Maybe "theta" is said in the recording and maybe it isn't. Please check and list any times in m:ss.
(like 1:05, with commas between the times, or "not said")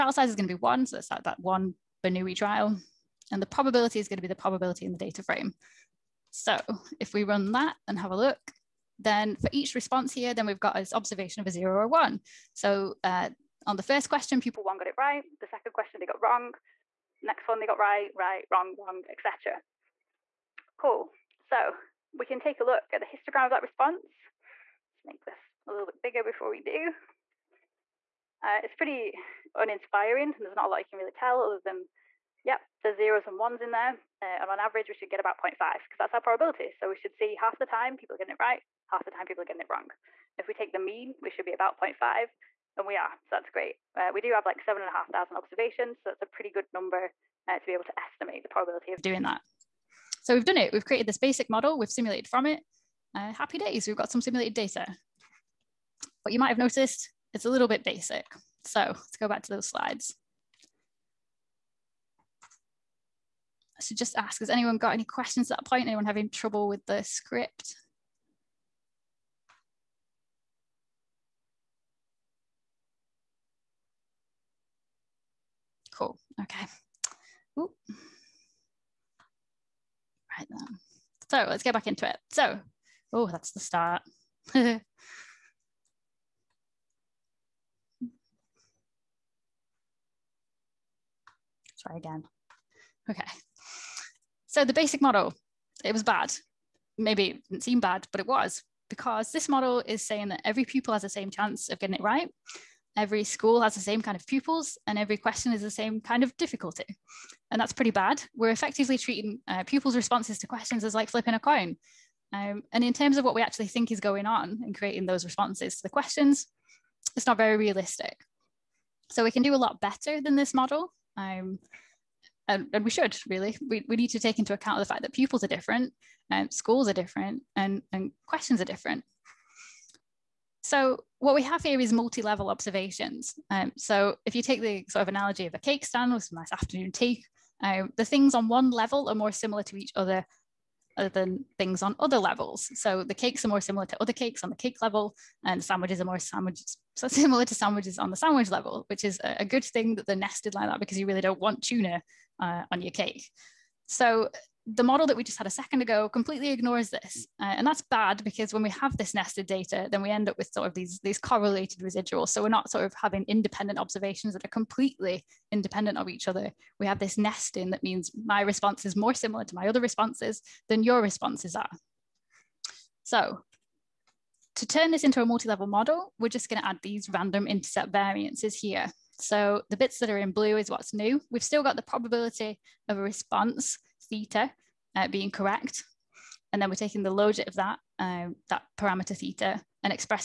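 3:04, 3:09.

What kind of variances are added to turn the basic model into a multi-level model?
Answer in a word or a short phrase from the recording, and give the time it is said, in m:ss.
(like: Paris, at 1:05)
random intercept variances, at 2:57.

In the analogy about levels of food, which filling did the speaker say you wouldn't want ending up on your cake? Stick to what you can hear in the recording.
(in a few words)
tuna.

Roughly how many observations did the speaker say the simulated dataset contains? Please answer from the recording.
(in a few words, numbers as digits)
7,500.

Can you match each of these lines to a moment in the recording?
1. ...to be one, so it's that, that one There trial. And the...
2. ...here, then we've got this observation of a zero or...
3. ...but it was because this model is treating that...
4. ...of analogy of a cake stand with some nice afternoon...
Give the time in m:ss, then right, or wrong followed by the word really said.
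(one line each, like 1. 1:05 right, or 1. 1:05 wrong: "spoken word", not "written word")
1. 0:00 wrong: "Bernoulli", not "There"
2. 0:10 right
3. 1:38 wrong: "saying", not "treating"
4. 2:15 right.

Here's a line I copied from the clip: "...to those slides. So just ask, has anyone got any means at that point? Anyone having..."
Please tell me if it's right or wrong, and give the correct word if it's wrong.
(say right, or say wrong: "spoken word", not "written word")
wrong: "questions", not "means".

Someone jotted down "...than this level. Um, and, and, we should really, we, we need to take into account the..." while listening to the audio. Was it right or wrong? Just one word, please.
wrong.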